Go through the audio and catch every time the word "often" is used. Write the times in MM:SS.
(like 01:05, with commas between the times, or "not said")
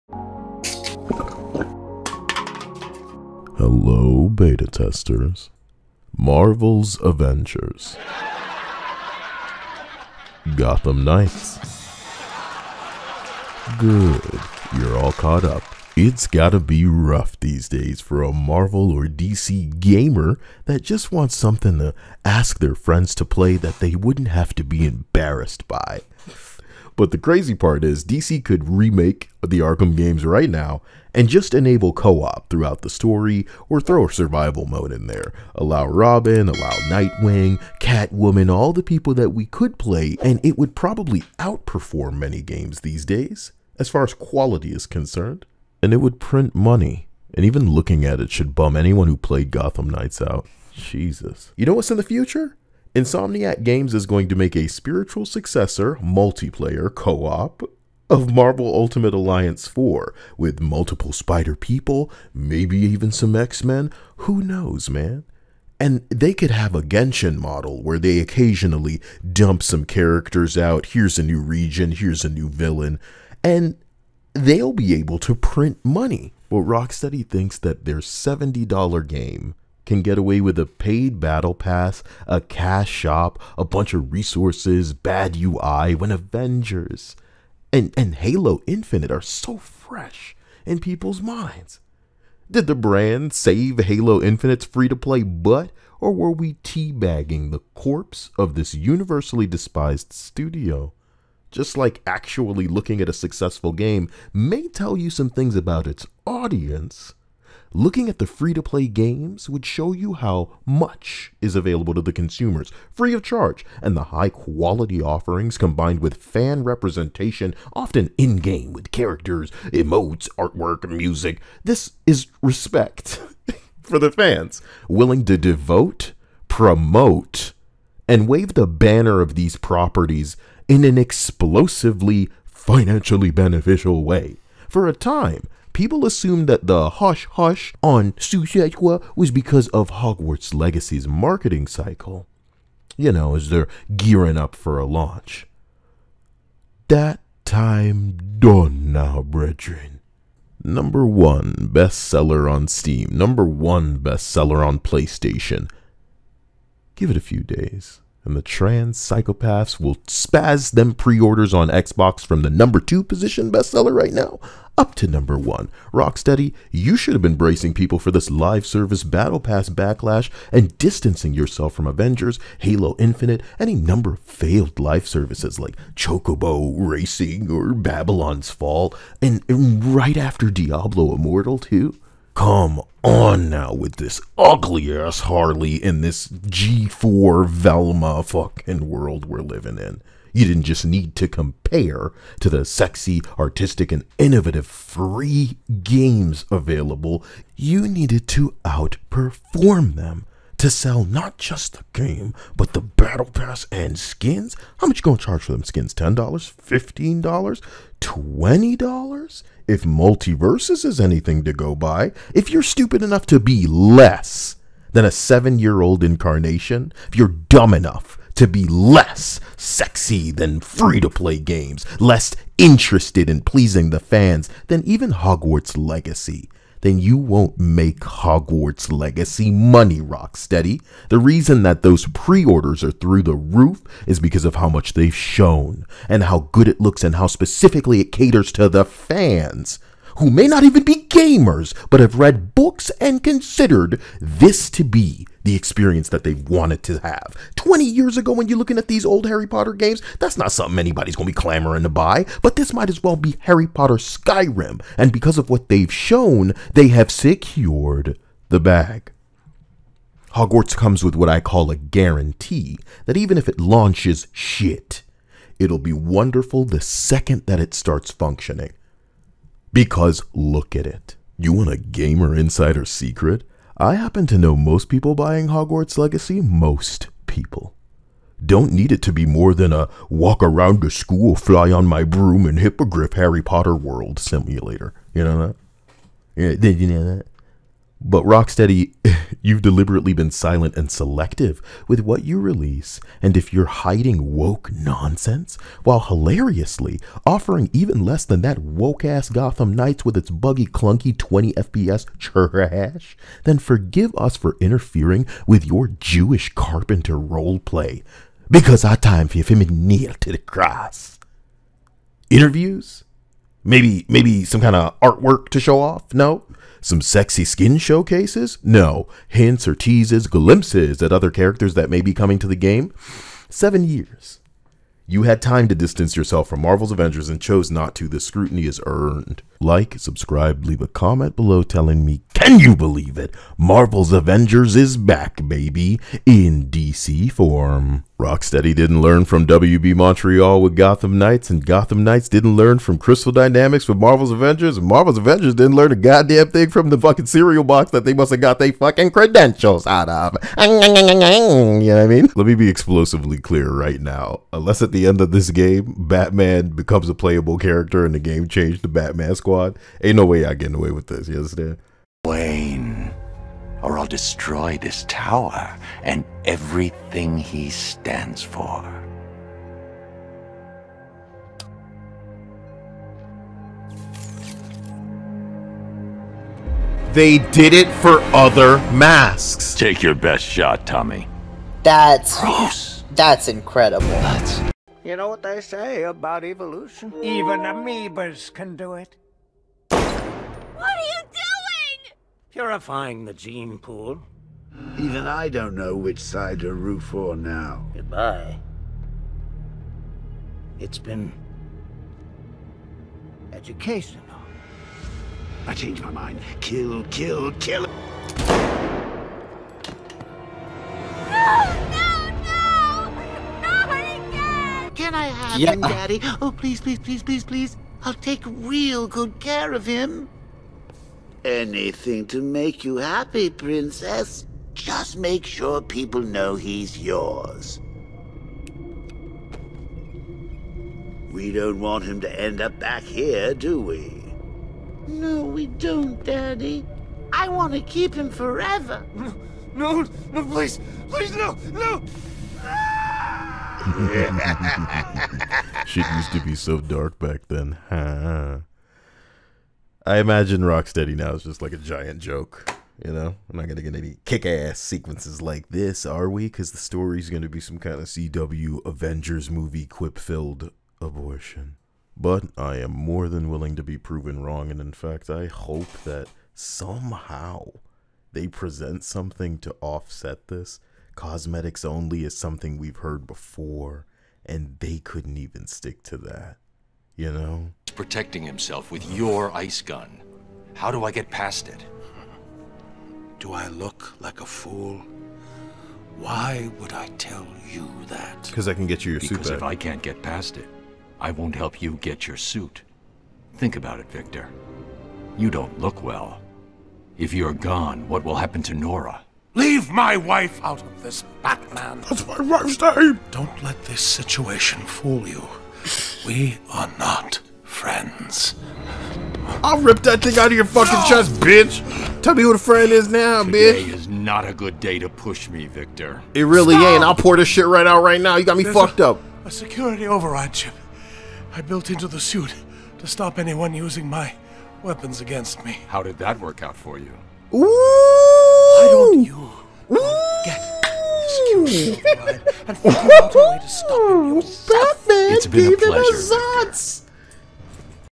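01:57.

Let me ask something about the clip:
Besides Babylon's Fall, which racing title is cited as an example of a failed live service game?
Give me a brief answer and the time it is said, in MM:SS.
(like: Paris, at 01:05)
Chocobo Racing, at 02:55.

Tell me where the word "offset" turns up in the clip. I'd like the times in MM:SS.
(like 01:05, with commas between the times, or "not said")
07:49.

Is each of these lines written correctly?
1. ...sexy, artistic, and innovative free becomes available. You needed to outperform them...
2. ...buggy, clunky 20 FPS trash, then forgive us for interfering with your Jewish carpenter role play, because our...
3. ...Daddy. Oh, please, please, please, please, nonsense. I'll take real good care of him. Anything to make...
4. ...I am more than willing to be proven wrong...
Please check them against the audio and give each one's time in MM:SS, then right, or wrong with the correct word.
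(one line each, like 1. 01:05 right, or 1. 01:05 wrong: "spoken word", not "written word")
1. 03:12 wrong: "games", not "becomes"
2. 05:00 right
3. 06:55 wrong: "please", not "nonsense"
4. 07:42 right.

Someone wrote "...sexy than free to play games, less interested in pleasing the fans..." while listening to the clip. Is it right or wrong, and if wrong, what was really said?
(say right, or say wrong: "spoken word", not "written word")
right.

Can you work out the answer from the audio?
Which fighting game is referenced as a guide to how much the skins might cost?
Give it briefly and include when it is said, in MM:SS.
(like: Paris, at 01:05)
MultiVersus, at 03:29.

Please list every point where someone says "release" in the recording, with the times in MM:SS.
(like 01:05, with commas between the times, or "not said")
04:52.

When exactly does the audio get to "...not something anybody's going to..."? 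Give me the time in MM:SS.
04:10.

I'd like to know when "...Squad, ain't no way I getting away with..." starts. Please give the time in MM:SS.
05:59.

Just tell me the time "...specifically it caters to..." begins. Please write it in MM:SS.
03:57.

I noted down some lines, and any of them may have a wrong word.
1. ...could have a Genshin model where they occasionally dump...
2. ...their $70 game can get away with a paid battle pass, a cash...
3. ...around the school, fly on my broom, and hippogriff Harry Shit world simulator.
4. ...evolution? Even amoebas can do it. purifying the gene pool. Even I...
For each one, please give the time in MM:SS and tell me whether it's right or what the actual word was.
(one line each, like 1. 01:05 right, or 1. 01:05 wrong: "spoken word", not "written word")
1. 01:06 right
2. 01:17 right
3. 04:40 wrong: "Potter", not "Shit"
4. 06:26 right.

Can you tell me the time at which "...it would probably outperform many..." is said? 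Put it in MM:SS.
00:40.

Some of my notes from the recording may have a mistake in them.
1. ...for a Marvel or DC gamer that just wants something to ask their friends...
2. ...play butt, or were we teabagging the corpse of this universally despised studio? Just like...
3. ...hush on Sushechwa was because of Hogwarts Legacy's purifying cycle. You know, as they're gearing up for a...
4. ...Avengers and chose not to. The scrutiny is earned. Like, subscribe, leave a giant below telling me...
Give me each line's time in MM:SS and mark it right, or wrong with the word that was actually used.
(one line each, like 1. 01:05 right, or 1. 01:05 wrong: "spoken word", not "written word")
1. 00:18 right
2. 01:34 right
3. 02:17 wrong: "marketing", not "purifying"
4. 05:26 wrong: "comment", not "giant".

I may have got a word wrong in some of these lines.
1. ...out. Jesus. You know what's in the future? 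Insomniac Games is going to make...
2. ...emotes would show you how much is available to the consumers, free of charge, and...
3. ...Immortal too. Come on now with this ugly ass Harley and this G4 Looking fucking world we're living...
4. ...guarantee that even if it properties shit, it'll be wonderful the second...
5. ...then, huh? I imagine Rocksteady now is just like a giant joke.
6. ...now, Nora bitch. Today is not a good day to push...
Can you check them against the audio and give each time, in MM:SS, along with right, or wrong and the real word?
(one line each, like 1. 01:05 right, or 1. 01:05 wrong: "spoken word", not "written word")
1. 00:50 right
2. 01:48 wrong: "games", not "emotes"
3. 03:01 wrong: "Velma", not "Looking"
4. 04:21 wrong: "launches", not "properties"
5. 07:27 right
6. 08:33 wrong: "Today", not "Nora".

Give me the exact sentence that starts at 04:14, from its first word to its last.
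And because of what they've shown, they have secured the bag.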